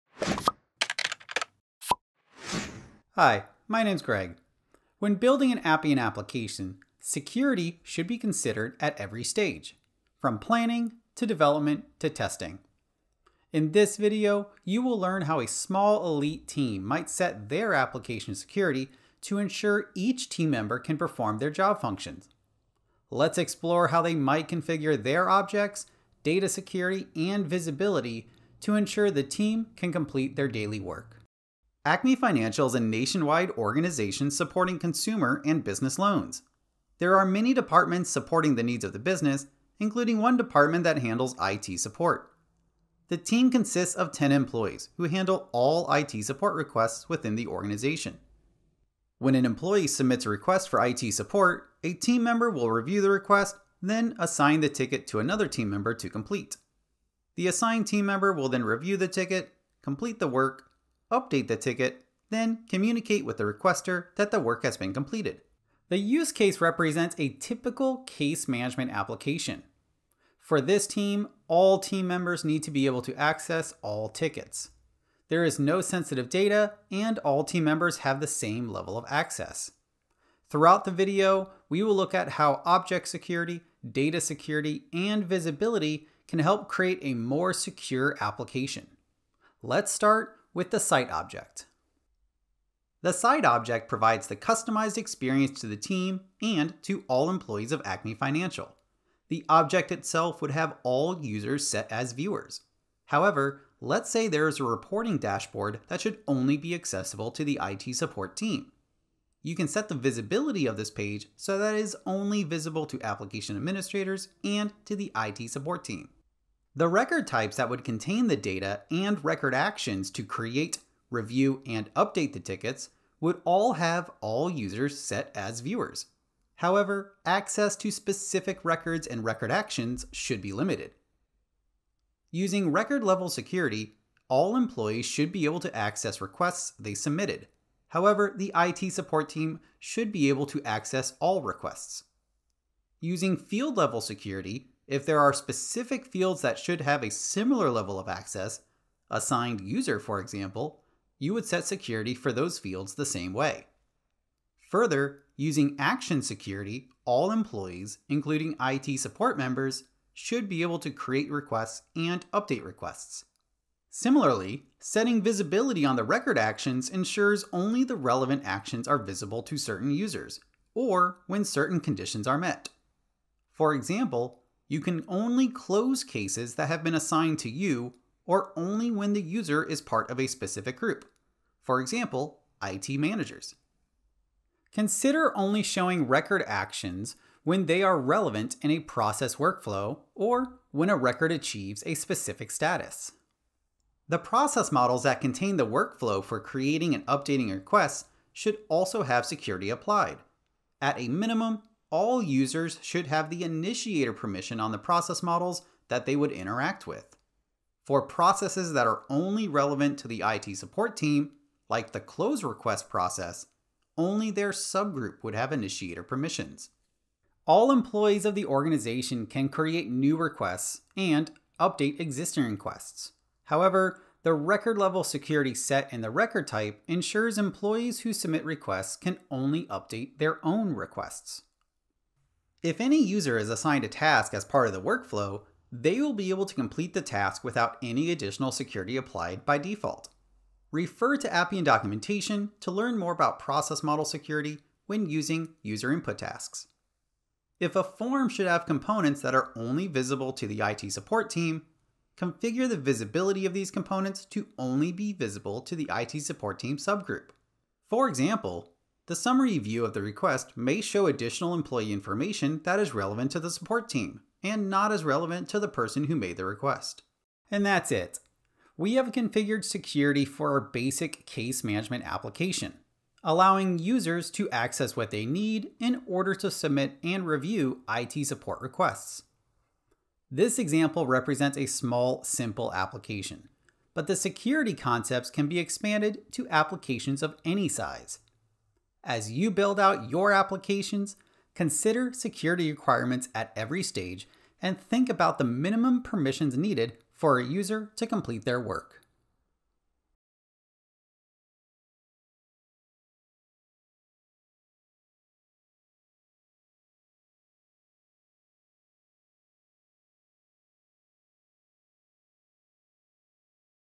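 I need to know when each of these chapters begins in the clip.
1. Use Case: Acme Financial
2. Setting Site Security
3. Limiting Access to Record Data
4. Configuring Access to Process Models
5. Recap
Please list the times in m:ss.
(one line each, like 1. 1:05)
1. 0:31
2. 1:32
3. 1:56
4. 3:13
5. 4:27.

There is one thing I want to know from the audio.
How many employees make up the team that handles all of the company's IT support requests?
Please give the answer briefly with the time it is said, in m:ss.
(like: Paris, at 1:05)
10, at 0:44.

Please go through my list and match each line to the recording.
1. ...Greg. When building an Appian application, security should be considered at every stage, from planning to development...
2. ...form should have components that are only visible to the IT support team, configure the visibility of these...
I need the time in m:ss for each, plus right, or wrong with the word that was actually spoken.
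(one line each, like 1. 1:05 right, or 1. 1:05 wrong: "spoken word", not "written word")
1. 0:04 right
2. 4:07 right.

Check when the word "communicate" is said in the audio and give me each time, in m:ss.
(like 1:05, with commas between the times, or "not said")
1:02.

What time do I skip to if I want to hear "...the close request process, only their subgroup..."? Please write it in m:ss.
3:31.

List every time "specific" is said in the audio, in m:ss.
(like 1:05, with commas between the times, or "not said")
2:07, 2:25, 3:00, 3:11.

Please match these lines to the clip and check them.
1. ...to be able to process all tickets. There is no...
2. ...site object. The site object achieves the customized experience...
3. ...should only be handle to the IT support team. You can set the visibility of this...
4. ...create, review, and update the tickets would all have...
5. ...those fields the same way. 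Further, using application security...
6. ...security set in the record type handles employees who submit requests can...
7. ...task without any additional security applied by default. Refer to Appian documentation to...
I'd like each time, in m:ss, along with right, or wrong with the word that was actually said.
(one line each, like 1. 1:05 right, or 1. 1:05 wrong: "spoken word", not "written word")
1. 1:12 wrong: "access", not "process"
2. 1:30 wrong: "provides", not "achieves"
3. 1:46 wrong: "accessible", not "handle"
4. 2:00 right
5. 2:32 wrong: "action", not "application"
6. 3:45 wrong: "ensures", not "handles"
7. 3:57 right.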